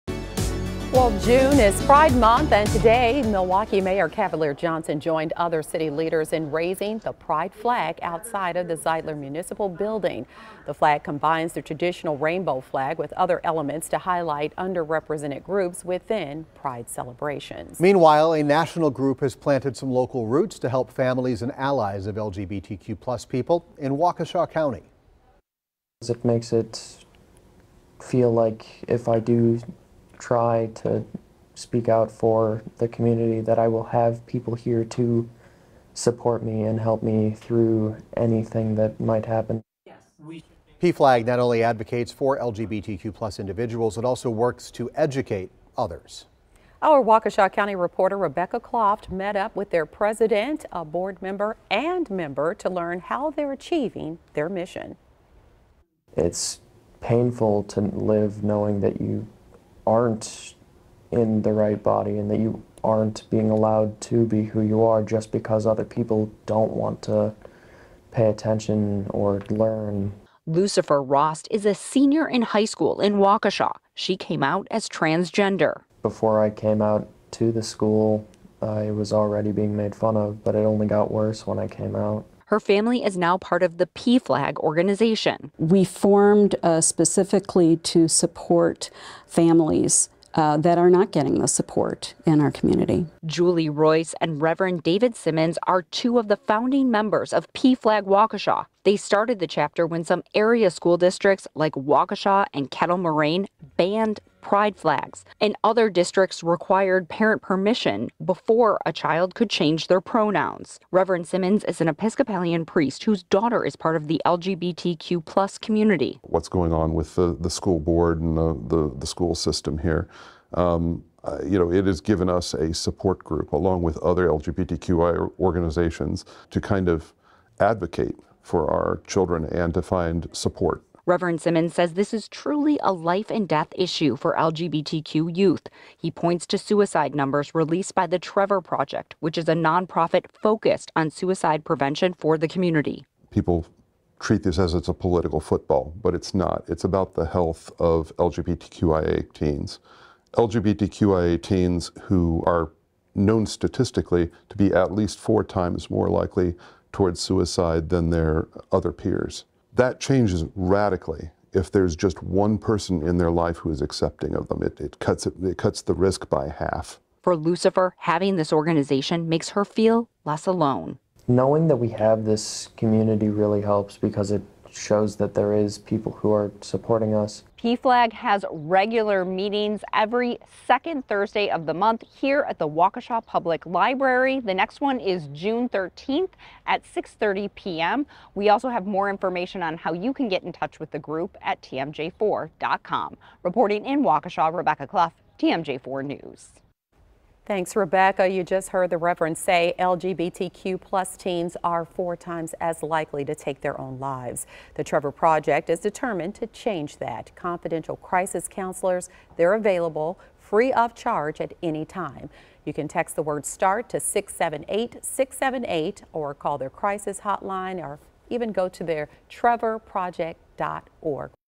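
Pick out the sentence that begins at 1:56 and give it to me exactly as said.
What's going on with the, the school board and the, the, the school system here?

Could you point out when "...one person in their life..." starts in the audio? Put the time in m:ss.
2:42.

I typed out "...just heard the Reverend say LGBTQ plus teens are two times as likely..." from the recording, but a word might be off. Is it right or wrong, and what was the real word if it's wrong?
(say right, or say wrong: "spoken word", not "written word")
wrong: "four", not "two".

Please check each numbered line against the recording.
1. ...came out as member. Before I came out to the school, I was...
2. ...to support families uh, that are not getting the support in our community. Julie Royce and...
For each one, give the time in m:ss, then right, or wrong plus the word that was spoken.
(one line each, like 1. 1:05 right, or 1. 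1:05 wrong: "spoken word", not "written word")
1. 1:14 wrong: "transgender", not "member"
2. 1:27 right.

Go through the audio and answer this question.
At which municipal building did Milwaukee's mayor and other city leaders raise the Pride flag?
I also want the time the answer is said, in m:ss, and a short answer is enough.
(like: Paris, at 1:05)
Zeidler Municipal Building, at 0:08.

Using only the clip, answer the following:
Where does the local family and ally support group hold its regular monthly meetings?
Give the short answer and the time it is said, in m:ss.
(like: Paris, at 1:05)
Waukesha Public Library, at 3:02.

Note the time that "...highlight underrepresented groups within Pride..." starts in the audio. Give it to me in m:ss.
0:13.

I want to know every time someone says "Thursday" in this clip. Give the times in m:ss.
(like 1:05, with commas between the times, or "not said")
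3:01.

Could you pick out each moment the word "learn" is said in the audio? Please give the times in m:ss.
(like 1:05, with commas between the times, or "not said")
0:52, 1:09.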